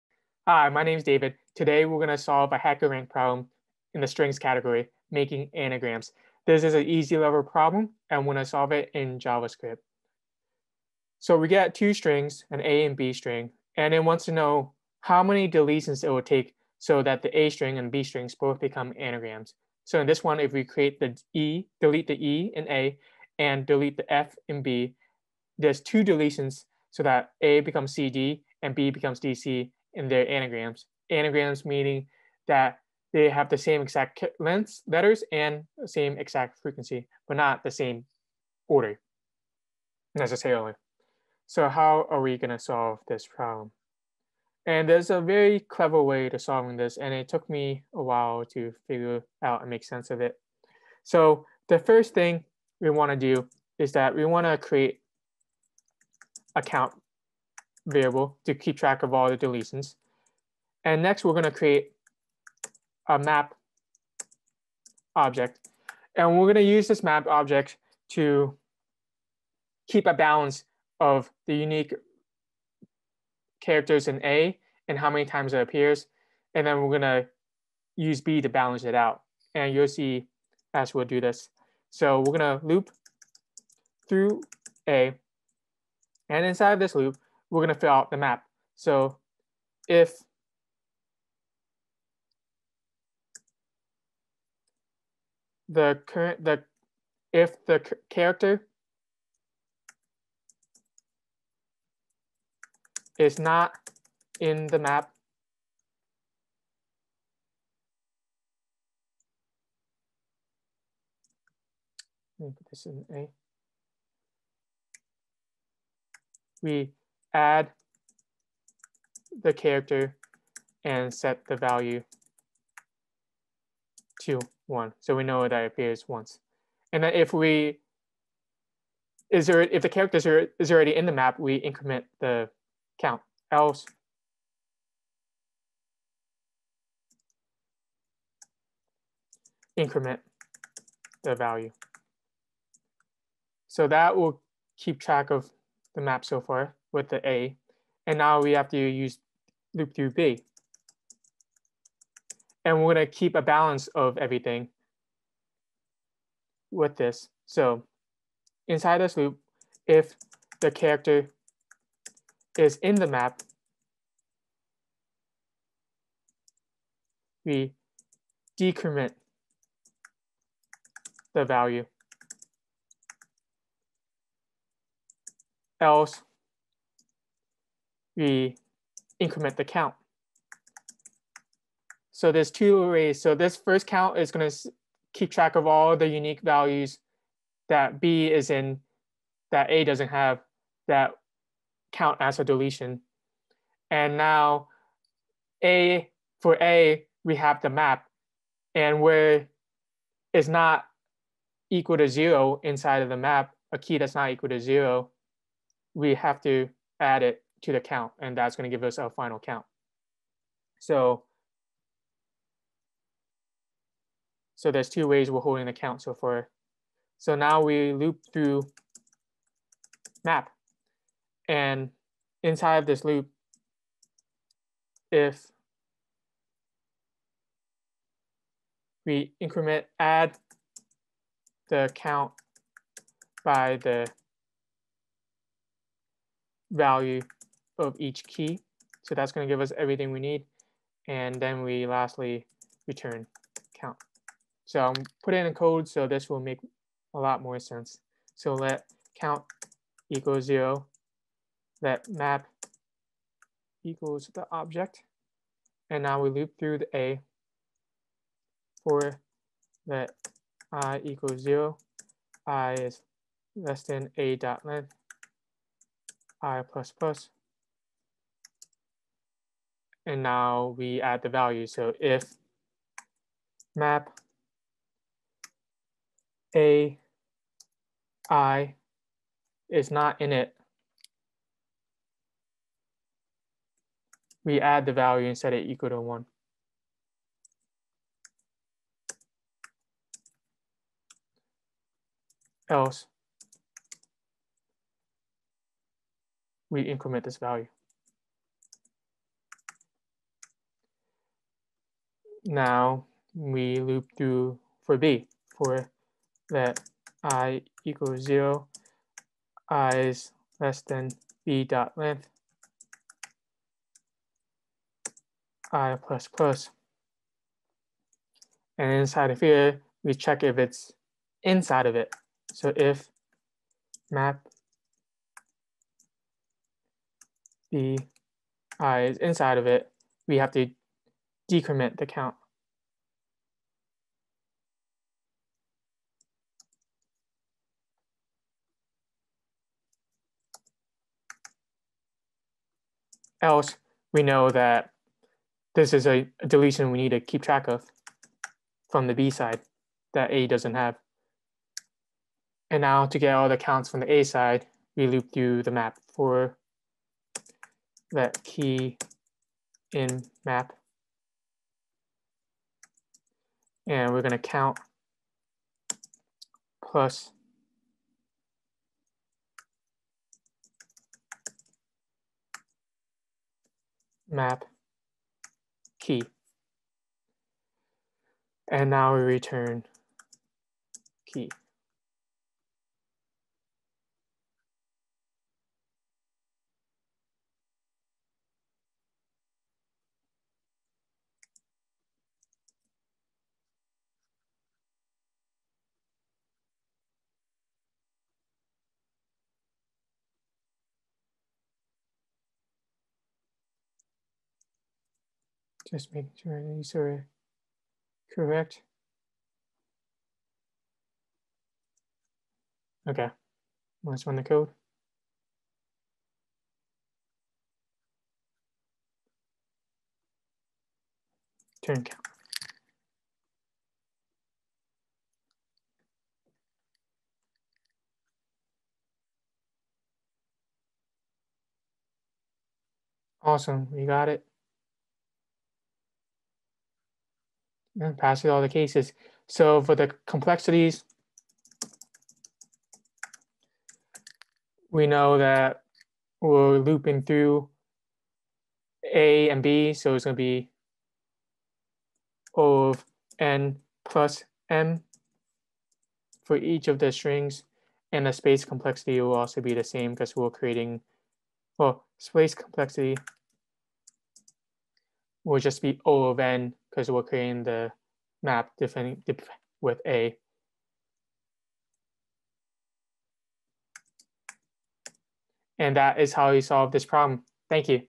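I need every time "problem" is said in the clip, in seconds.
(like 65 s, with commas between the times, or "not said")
3 s, 7 s, 43 s, 477 s.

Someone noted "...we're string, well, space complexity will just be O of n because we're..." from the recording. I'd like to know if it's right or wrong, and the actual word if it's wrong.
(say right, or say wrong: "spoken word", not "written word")
wrong: "creating", not "string".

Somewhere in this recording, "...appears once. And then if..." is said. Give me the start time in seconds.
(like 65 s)
125 s.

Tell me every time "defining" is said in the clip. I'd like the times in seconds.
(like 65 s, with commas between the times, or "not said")
468 s.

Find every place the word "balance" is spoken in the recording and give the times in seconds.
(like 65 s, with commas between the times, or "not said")
70 s, 78 s, 153 s.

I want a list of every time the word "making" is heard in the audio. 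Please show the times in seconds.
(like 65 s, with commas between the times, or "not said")
5 s, 406 s.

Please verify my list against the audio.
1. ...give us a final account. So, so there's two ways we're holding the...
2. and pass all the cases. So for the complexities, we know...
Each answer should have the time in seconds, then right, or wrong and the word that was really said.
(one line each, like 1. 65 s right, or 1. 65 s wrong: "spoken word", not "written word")
1. 208 s wrong: "count", not "account"
2. 438 s right.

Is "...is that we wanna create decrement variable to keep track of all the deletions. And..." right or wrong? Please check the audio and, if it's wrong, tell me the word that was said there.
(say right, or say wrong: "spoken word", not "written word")
wrong: "account", not "decrement".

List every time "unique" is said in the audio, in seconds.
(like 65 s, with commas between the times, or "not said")
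71 s, 186 s.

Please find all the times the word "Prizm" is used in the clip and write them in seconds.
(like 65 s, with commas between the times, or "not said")
not said.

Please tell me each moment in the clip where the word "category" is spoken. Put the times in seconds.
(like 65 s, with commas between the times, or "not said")
4 s.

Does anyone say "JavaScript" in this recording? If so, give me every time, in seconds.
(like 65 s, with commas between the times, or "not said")
9 s.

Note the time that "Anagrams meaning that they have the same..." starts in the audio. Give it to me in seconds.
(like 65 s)
31 s.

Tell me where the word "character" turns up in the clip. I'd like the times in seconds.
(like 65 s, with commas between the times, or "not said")
73 s, 98 s, 119 s, 129 s, 160 s.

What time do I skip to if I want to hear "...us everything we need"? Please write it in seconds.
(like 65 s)
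239 s.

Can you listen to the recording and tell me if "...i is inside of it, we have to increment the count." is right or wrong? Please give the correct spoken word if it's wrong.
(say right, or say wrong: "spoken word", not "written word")
wrong: "decrement", not "increment".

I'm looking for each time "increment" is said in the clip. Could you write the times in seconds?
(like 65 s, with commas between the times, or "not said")
131 s, 139 s, 179 s, 229 s, 296 s.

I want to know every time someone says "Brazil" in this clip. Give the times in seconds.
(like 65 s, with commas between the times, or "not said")
not said.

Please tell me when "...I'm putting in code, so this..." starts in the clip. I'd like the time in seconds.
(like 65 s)
244 s.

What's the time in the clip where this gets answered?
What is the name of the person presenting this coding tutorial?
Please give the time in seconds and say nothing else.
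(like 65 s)
1 s.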